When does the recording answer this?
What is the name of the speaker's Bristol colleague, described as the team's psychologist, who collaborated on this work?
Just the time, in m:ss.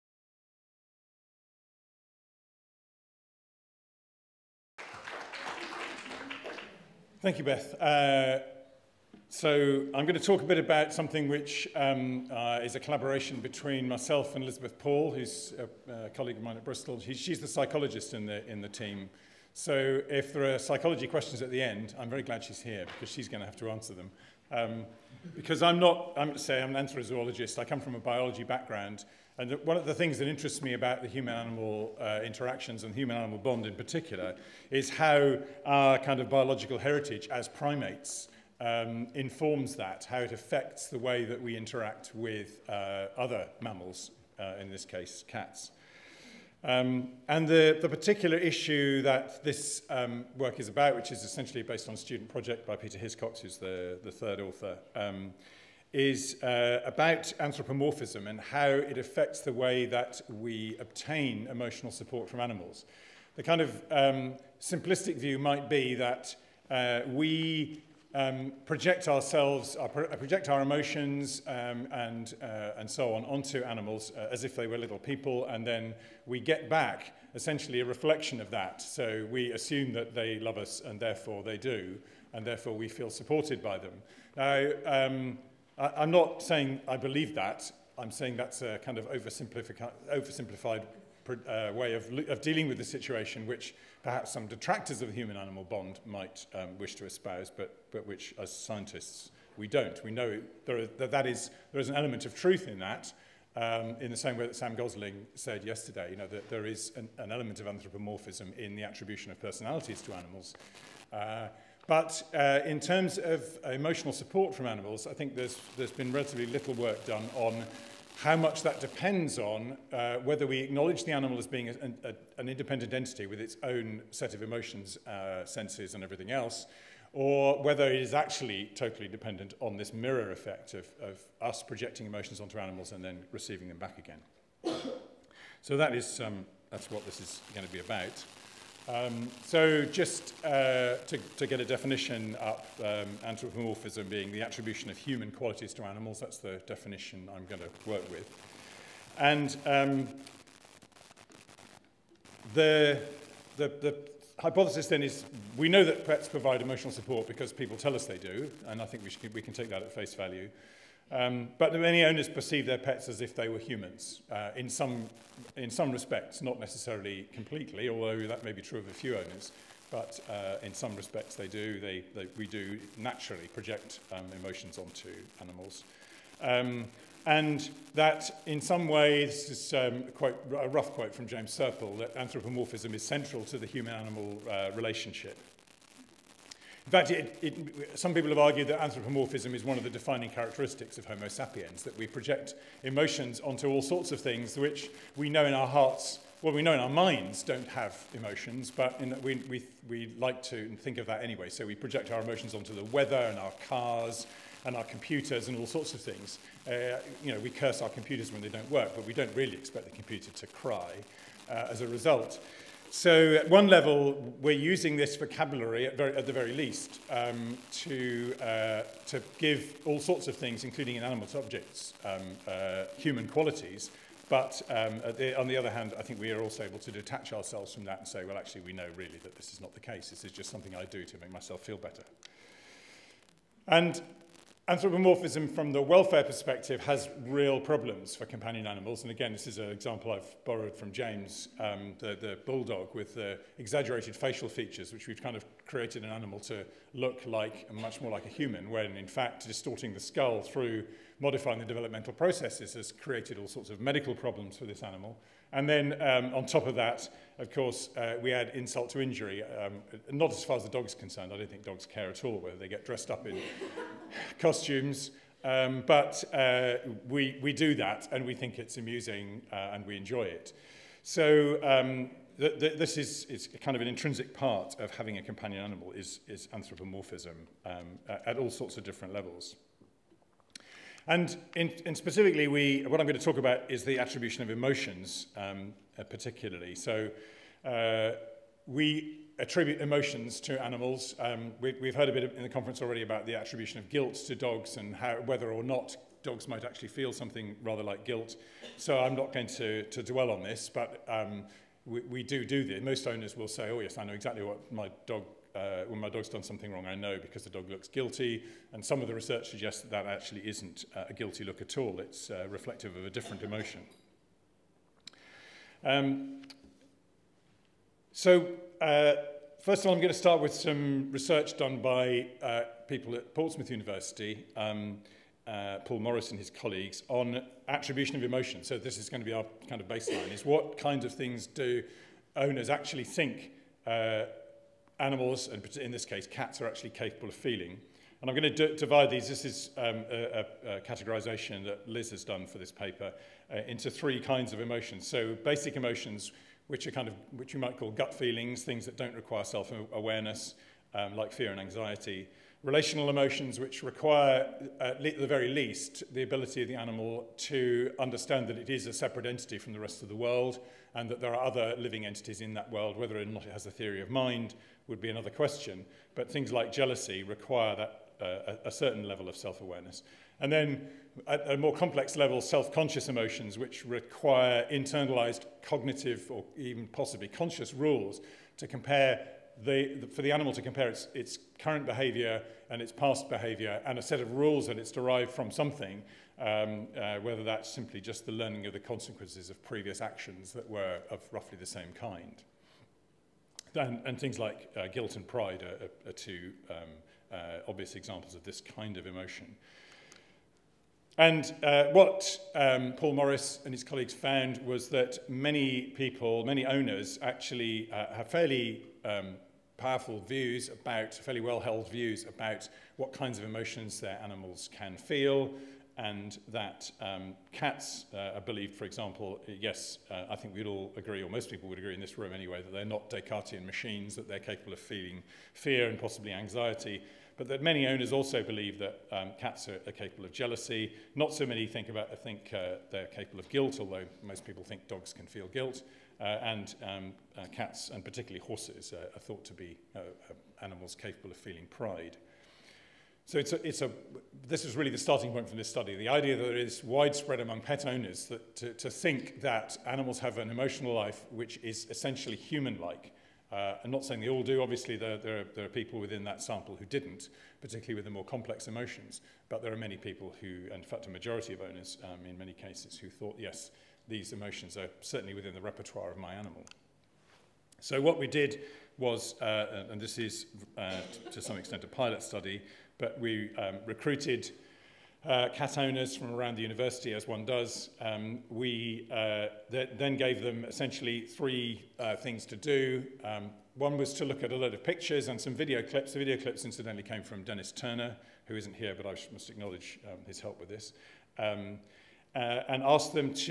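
0:14.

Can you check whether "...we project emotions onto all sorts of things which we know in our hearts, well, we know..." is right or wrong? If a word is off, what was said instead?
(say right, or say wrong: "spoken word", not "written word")
right.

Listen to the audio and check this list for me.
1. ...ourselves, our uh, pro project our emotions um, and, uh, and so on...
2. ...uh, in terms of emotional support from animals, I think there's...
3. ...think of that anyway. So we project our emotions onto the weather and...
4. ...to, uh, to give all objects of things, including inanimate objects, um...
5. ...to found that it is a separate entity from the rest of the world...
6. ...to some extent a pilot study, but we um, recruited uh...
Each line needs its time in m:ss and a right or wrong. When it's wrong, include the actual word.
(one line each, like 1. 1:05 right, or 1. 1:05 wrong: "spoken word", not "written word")
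1. 1:09 right
2. 1:52 right
3. 3:20 right
4. 3:37 wrong: "sorts", not "objects"
5. 5:57 wrong: "understand", not "found"
6. 7:51 right.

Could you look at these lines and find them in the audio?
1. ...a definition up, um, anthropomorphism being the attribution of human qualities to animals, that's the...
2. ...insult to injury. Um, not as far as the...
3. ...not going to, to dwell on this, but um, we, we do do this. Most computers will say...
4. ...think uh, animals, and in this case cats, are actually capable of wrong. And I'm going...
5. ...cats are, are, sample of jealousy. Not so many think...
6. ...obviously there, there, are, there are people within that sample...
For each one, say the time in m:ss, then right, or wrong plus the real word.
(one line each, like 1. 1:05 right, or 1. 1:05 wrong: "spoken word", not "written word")
1. 2:21 right
2. 4:18 right
3. 4:59 wrong: "owners", not "computers"
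4. 5:33 wrong: "feeling", not "wrong"
5. 7:09 wrong: "capable", not "sample"
6. 7:34 right.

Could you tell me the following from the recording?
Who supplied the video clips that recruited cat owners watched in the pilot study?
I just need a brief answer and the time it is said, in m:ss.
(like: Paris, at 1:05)
Dennis Turner, at 8:07.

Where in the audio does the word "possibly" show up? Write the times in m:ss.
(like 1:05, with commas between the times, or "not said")
6:16, 7:05.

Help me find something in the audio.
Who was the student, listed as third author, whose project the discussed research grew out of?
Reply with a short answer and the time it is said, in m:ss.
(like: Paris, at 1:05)
Peter Hiscox, at 0:52.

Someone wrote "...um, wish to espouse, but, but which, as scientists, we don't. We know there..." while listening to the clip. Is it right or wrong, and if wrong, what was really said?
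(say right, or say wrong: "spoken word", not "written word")
right.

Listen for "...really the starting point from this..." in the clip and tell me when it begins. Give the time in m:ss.
7:24.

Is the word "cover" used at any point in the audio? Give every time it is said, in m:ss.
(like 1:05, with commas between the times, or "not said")
not said.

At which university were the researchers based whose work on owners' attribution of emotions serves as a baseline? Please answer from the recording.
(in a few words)
Portsmouth University.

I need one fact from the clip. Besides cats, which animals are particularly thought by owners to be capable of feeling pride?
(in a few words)
Horses.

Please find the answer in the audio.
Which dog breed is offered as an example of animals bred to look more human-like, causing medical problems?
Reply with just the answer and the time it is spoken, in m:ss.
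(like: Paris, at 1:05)
Bulldog, at 4:02.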